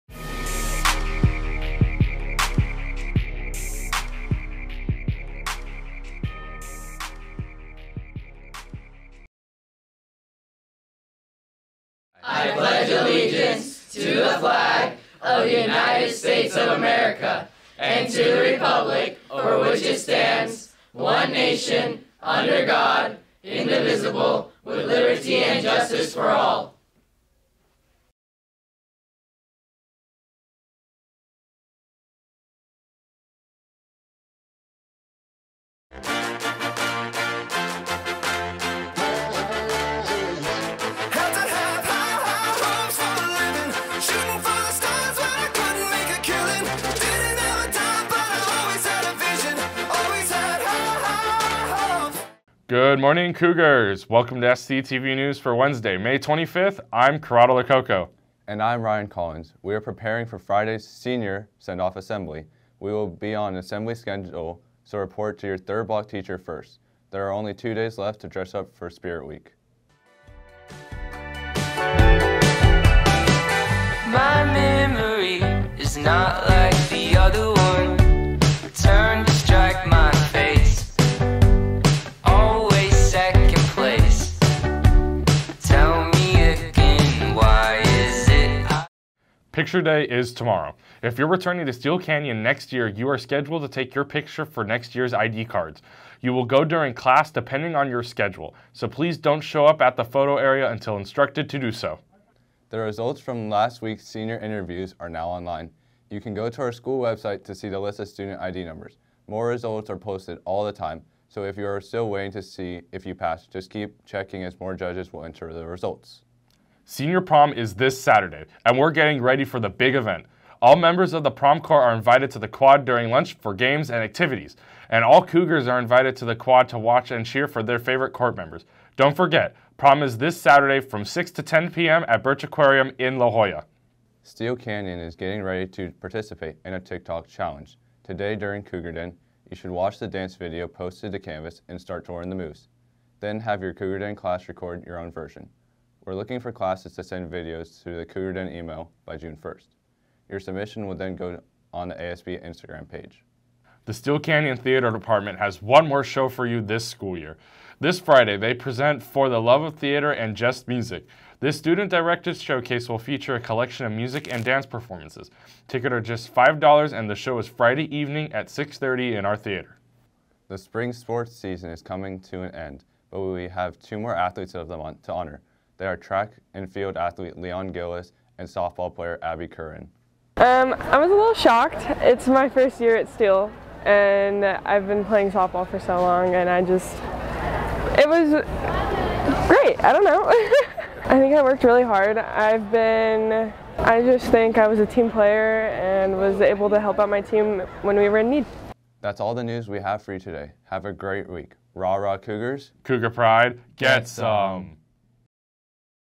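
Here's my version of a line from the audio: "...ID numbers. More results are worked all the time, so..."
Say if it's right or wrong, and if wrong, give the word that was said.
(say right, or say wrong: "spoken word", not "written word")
wrong: "posted", not "worked".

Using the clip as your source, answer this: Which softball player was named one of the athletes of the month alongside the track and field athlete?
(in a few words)
Abby Curran.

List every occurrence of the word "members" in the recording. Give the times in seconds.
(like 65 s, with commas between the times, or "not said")
120 s, 128 s.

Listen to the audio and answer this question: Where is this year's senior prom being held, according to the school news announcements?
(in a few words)
Birch Aquarium.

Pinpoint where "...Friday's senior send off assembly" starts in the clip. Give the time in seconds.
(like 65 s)
60 s.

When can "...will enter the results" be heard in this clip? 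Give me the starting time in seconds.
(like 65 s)
115 s.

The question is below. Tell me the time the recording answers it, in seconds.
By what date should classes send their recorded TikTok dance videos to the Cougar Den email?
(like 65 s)
149 s.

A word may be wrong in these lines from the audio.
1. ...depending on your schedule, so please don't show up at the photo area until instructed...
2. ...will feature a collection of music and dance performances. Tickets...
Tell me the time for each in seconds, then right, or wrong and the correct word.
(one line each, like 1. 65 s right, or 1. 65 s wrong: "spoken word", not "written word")
1. 97 s right
2. 162 s right.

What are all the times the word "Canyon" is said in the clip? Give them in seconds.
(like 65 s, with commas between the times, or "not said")
91 s, 134 s, 154 s.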